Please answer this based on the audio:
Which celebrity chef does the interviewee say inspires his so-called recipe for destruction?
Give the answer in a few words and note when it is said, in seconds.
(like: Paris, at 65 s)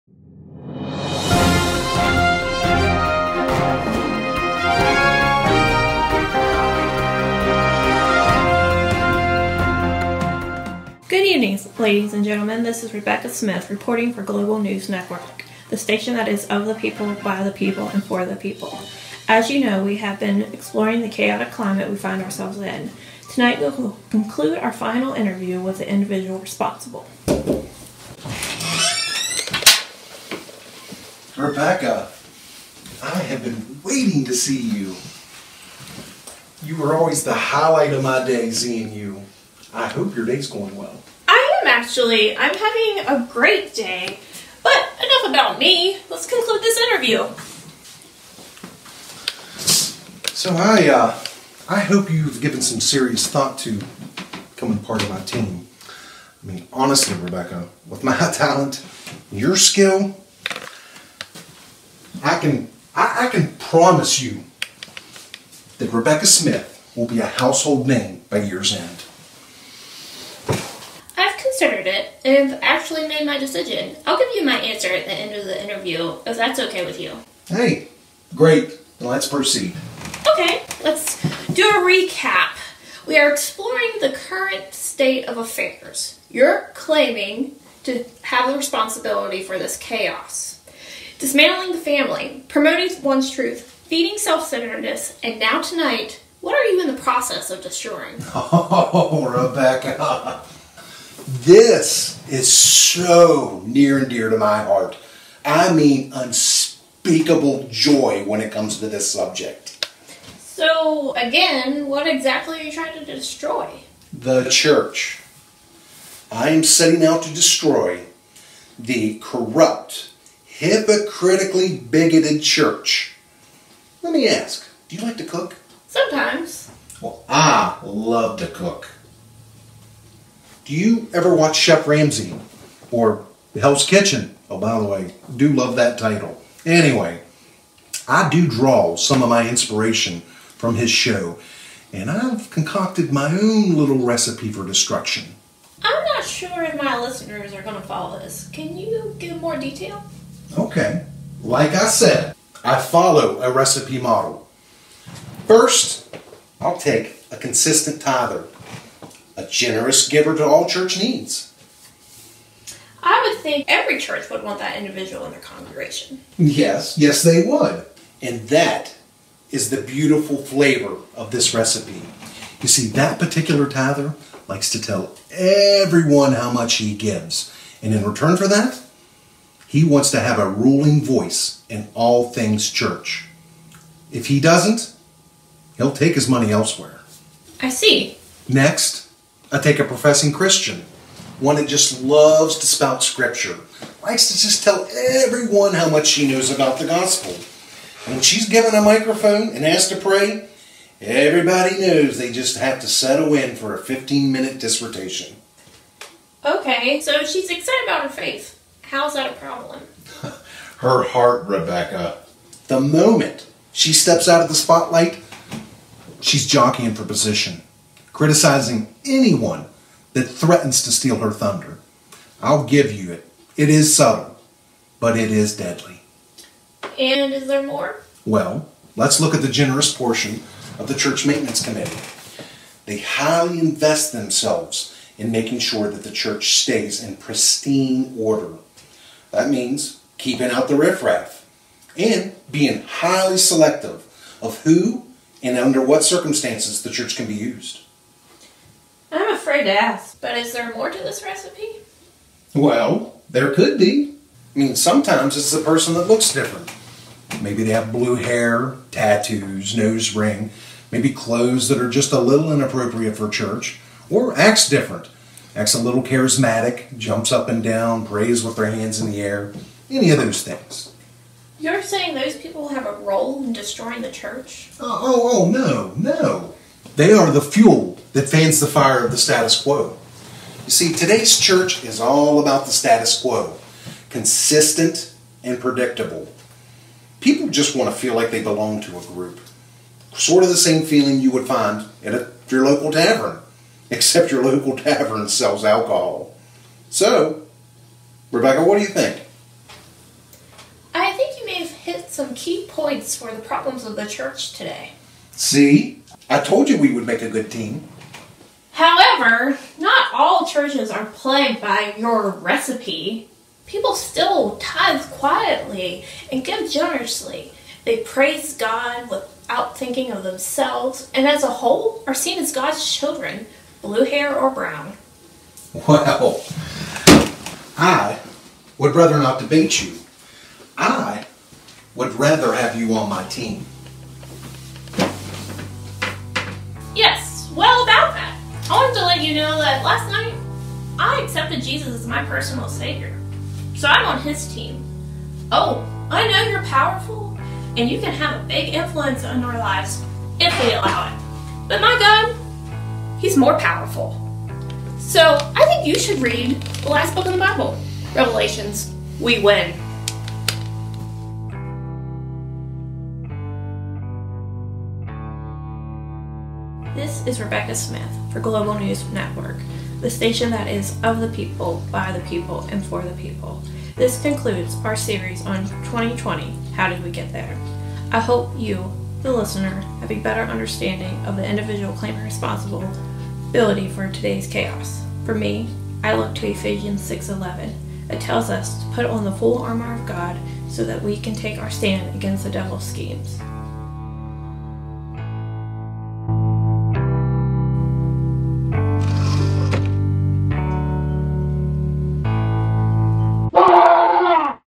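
Chef Ramsay, at 131 s.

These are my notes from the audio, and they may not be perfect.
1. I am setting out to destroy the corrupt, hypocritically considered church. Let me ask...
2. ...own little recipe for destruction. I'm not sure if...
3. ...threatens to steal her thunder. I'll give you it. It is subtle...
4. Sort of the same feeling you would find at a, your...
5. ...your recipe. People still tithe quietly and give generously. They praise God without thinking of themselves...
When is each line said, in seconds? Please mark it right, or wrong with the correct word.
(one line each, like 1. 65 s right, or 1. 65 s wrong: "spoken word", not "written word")
1. 116 s wrong: "bigoted", not "considered"
2. 143 s right
3. 220 s right
4. 290 s right
5. 311 s right.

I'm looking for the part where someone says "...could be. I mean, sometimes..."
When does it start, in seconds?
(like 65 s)
253 s.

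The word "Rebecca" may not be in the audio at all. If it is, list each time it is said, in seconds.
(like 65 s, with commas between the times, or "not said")
12 s, 31 s, 57 s, 65 s, 99 s, 211 s, 298 s, 367 s.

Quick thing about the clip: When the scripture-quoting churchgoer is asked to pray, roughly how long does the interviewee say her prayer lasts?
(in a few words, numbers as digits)
15 minutes.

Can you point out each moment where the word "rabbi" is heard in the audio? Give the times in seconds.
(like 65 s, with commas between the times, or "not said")
not said.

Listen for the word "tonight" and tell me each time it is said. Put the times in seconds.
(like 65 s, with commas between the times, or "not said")
23 s, 95 s.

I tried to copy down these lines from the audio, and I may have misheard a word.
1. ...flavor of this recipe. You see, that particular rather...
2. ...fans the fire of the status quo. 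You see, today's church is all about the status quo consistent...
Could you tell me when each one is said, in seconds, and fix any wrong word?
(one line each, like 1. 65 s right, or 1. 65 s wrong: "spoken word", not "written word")
1. 170 s wrong: "tither", not "rather"
2. 278 s right.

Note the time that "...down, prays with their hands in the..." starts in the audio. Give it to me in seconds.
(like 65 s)
267 s.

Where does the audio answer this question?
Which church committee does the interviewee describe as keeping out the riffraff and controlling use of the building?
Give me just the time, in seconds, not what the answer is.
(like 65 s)
231 s.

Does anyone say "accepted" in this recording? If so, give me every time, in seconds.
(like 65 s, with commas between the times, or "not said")
341 s.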